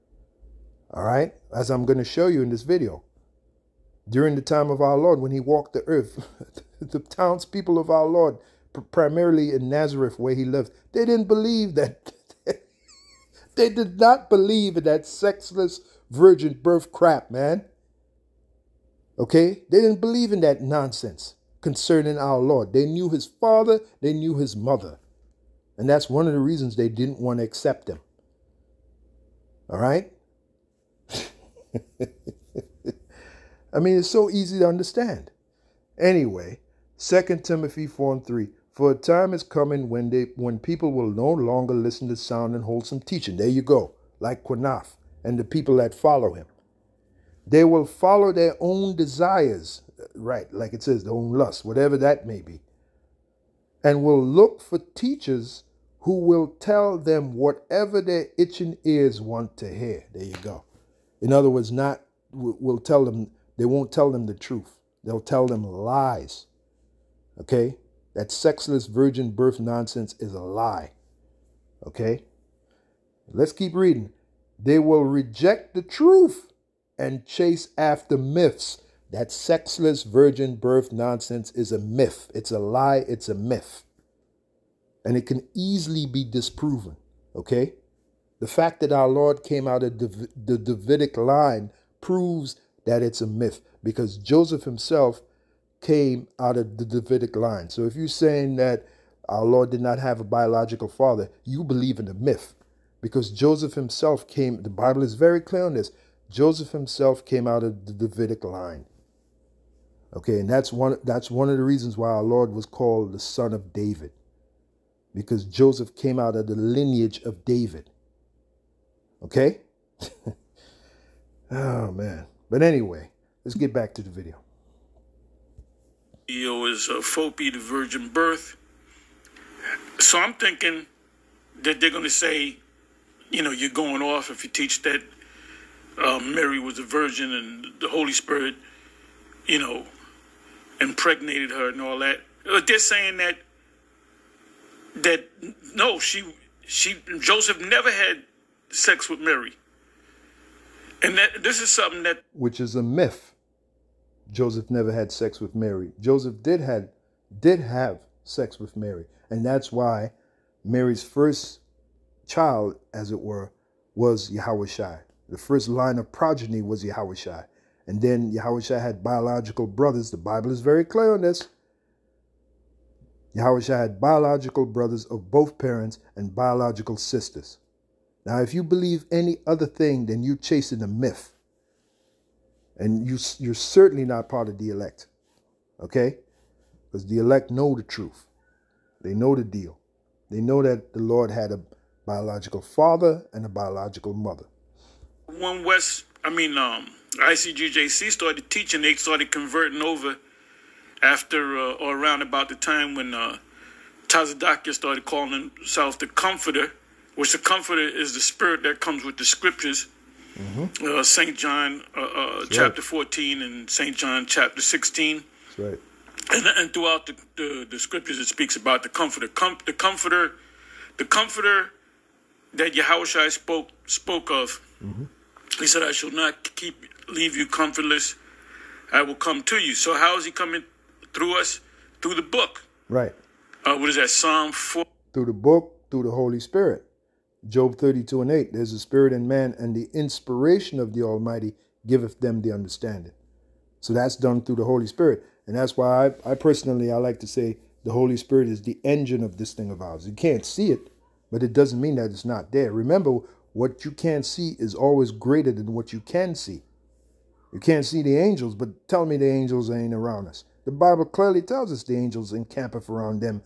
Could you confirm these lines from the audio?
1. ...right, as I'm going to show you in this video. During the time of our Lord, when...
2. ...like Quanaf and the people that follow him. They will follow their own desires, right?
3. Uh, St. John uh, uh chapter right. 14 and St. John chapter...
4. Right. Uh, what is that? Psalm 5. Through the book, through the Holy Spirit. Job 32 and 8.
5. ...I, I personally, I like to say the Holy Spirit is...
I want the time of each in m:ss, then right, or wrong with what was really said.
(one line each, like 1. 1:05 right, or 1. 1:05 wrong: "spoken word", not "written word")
1. 0:01 right
2. 0:44 right
3. 3:30 right
4. 3:52 wrong: "4", not "5"
5. 4:06 right.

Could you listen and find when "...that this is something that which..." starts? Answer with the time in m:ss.
2:31.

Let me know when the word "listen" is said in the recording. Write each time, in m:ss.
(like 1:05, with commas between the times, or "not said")
0:41.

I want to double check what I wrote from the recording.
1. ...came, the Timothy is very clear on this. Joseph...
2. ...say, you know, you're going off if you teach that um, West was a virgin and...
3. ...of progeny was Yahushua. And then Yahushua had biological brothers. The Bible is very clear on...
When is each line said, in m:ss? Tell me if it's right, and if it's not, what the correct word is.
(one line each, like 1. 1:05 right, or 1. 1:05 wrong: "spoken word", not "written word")
1. 1:44 wrong: "Bible", not "Timothy"
2. 2:12 wrong: "Mary", not "West"
3. 2:45 right.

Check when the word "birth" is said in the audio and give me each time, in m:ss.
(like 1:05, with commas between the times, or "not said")
0:16, 1:09, 1:20, 2:08.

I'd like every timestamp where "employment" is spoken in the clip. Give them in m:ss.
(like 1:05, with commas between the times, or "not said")
not said.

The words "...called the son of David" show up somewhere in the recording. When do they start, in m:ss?
1:52.